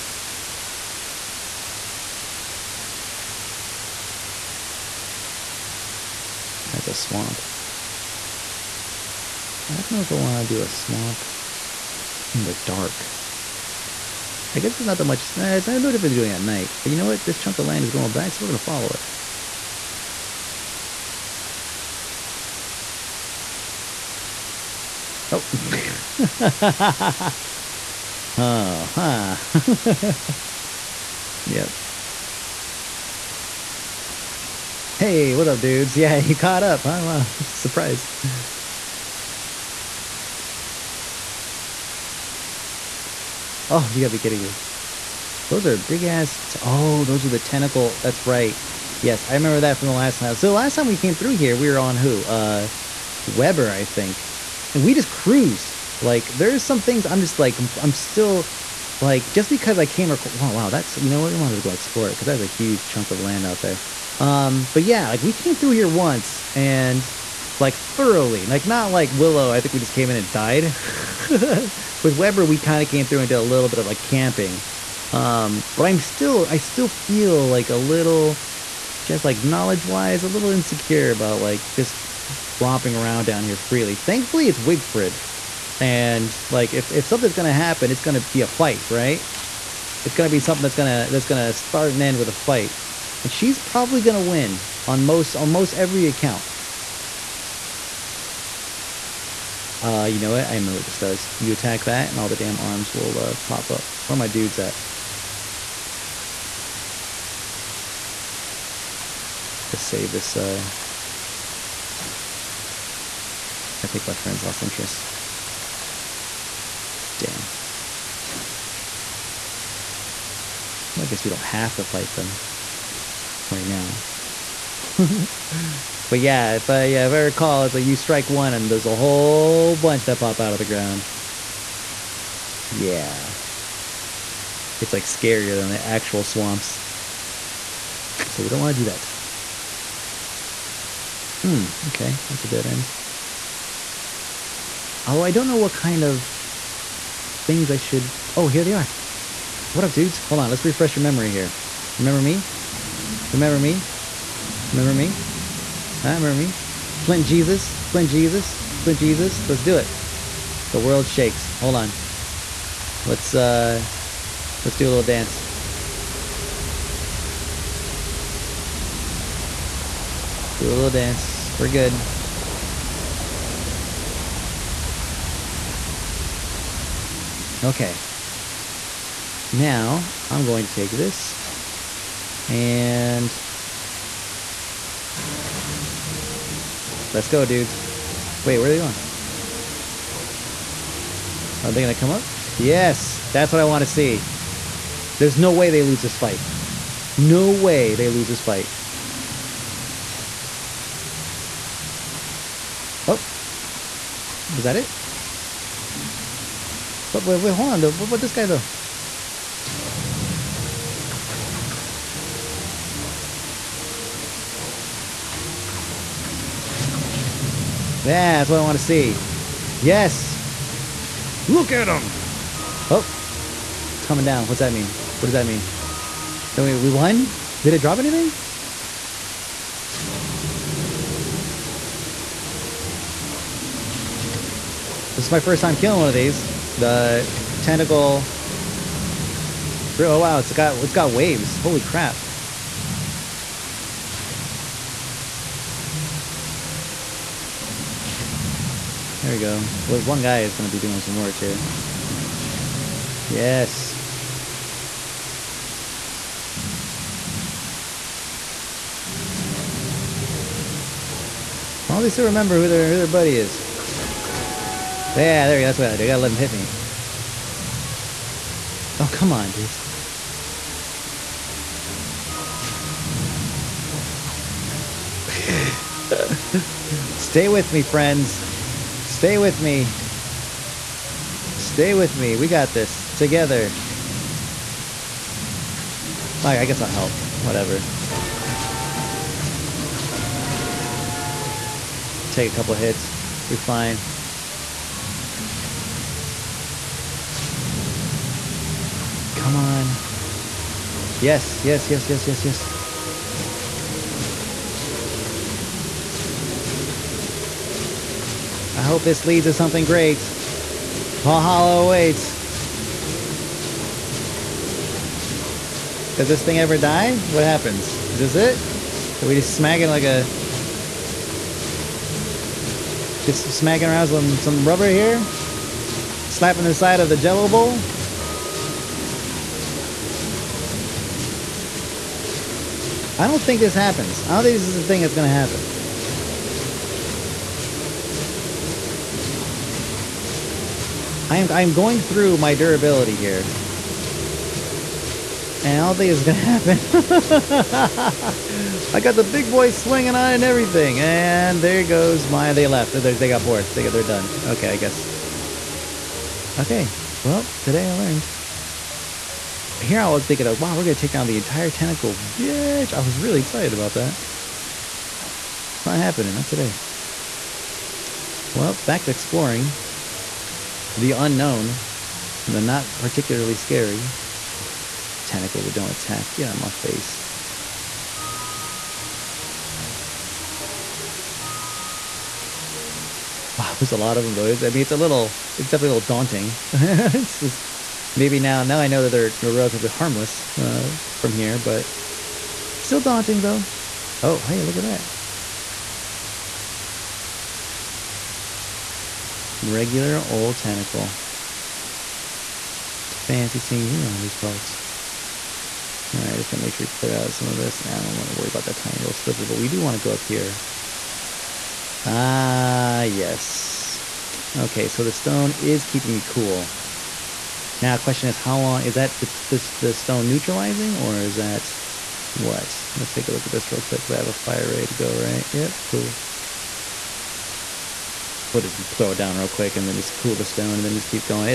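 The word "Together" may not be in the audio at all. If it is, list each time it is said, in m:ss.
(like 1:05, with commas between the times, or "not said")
4:43.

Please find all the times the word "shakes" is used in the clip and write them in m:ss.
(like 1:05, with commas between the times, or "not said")
2:41.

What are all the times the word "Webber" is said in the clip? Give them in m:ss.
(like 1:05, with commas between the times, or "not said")
0:53, 1:12.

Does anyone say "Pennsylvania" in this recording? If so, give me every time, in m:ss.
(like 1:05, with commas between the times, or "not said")
not said.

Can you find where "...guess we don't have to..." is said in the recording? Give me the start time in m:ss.
2:01.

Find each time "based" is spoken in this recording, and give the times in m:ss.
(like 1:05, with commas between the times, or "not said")
not said.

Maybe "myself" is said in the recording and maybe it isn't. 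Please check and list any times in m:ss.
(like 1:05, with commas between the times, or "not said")
not said.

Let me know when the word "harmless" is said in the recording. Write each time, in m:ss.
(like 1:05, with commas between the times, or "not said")
6:29.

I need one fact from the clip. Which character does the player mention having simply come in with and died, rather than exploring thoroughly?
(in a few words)
Willow.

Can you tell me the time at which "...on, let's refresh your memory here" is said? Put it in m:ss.
2:30.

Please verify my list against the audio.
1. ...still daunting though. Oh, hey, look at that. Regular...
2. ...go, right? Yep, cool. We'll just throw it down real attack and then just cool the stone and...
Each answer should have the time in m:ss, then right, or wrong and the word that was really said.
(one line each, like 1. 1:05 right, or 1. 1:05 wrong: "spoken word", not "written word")
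1. 6:32 right
2. 7:04 wrong: "quick", not "attack".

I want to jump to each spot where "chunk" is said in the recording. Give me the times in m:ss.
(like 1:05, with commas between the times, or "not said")
0:17, 1:02.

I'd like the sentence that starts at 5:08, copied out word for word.
I hope this leads to something great.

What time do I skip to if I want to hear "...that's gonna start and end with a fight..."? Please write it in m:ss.
1:31.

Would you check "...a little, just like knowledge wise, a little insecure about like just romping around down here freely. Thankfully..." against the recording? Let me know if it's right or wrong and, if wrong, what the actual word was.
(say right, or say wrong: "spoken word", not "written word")
right.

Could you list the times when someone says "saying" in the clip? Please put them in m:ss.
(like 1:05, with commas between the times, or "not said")
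not said.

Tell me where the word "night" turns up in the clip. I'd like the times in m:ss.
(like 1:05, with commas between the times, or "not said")
0:16.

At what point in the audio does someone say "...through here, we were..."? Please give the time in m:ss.
0:51.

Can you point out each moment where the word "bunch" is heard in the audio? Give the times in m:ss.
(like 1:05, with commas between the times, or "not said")
2:09.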